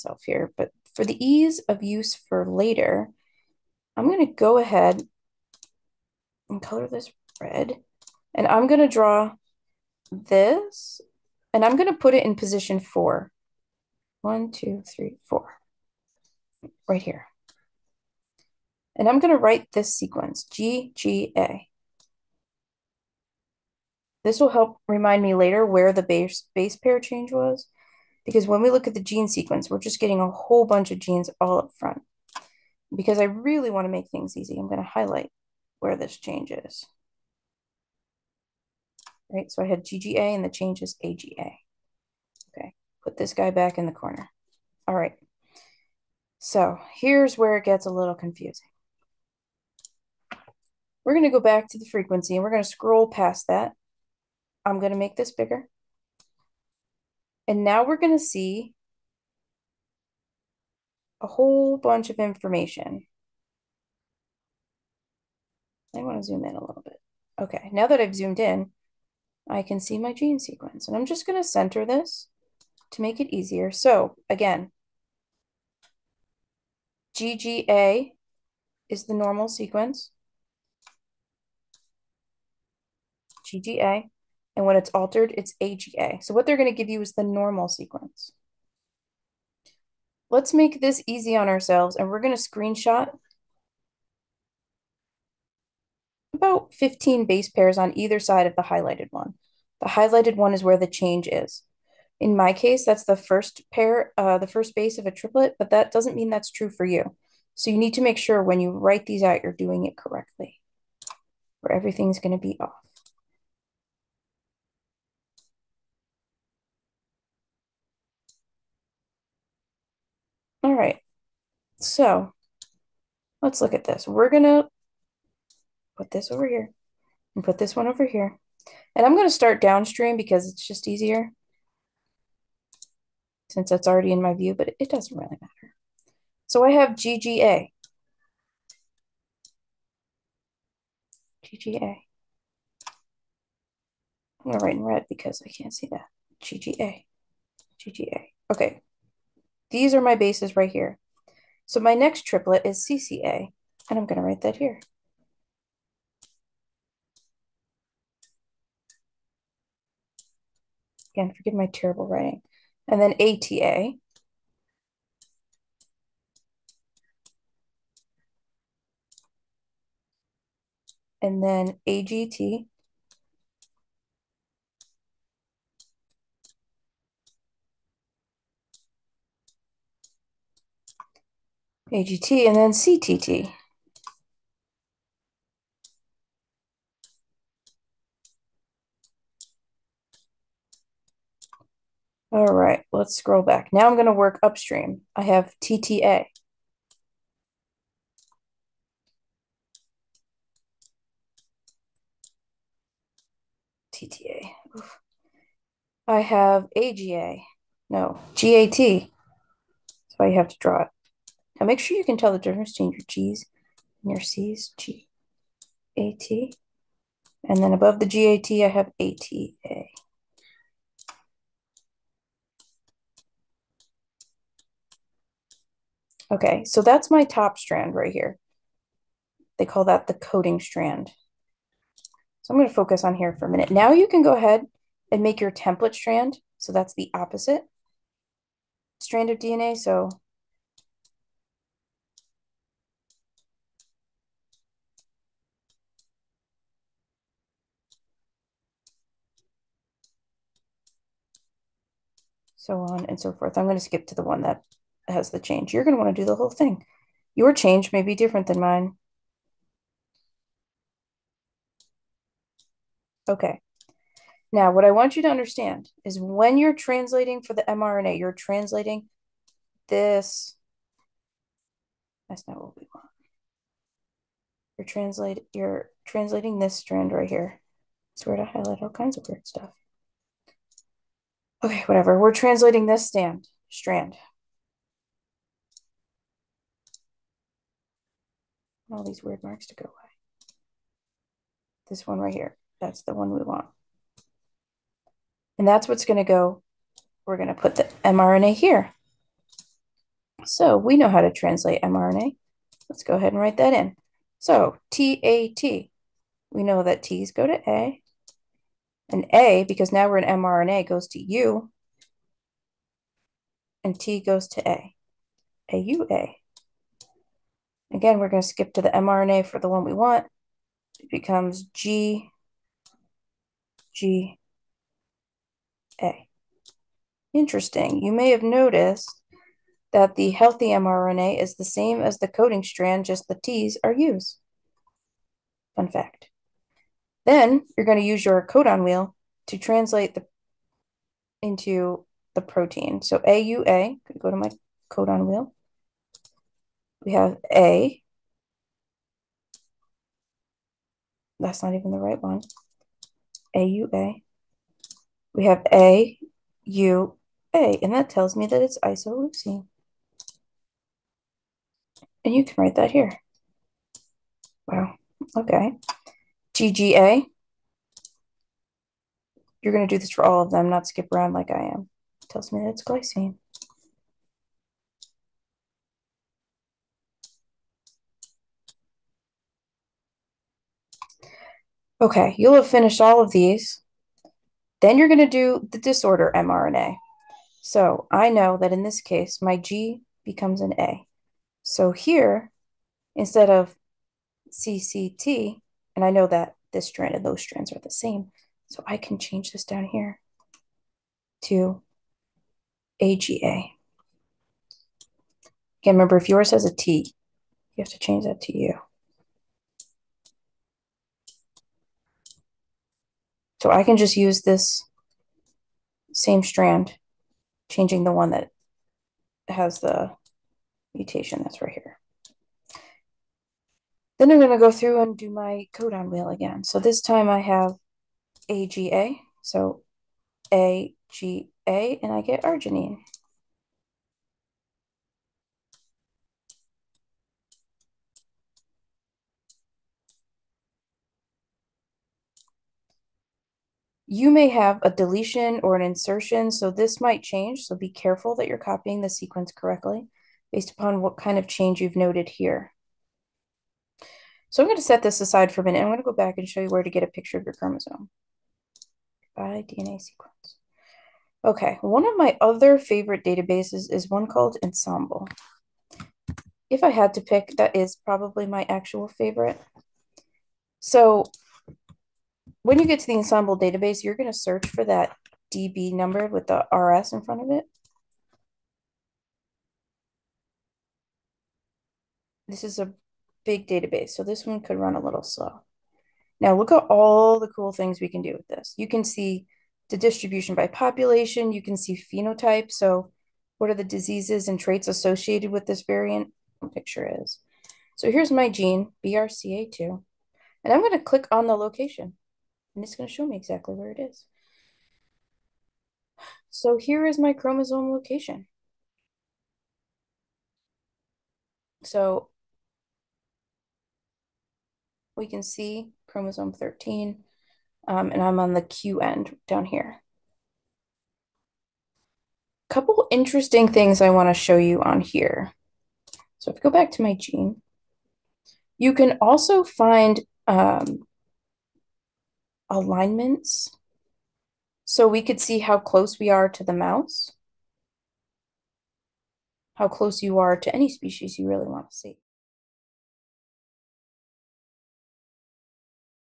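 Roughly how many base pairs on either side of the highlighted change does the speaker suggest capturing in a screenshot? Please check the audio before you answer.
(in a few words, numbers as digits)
15.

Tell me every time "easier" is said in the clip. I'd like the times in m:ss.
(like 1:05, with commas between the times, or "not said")
1:13, 2:10.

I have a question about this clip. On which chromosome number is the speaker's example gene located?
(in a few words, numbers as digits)
13.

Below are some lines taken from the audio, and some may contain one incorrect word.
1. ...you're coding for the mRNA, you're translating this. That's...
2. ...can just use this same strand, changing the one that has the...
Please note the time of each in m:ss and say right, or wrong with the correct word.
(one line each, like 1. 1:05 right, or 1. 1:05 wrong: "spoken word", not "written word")
1. 4:26 wrong: "translating", not "coding"
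2. 6:53 right.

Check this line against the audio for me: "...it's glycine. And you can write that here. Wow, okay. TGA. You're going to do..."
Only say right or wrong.
wrong.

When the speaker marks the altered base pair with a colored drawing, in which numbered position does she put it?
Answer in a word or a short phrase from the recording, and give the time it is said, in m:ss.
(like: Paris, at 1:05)
4, at 0:12.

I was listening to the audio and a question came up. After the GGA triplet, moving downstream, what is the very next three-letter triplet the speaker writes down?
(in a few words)
CCA.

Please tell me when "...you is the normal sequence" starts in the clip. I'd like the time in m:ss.
1:26.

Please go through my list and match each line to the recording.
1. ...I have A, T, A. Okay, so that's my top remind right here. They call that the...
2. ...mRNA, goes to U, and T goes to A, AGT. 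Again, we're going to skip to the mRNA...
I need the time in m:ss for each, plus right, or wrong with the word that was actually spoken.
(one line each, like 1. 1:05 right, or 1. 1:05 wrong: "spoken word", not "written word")
1. 3:38 wrong: "strand", not "remind"
2. 5:10 wrong: "AUA", not "AGT".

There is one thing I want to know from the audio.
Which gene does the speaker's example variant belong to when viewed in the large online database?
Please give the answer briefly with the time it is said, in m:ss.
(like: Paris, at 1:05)
BRCA2, at 8:19.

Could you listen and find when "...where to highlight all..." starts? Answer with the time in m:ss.
4:38.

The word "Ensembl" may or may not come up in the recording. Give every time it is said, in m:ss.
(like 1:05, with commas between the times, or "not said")
7:44, 7:53.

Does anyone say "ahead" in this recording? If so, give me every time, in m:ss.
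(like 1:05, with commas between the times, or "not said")
0:04, 3:54, 5:03.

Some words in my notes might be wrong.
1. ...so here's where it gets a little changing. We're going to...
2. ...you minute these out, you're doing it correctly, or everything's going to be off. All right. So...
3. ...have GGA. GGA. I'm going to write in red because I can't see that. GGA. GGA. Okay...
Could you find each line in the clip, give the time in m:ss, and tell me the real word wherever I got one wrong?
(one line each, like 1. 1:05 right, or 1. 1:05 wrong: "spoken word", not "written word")
1. 0:46 wrong: "confusing", not "changing"
2. 1:48 wrong: "write", not "minute"
3. 2:16 right.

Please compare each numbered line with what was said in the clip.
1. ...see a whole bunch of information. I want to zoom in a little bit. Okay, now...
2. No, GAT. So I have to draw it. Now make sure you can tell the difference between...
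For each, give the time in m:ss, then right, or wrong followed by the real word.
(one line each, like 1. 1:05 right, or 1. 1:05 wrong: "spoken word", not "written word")
1. 0:58 right
2. 3:27 right.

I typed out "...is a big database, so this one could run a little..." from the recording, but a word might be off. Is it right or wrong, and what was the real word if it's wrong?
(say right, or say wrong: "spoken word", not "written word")
right.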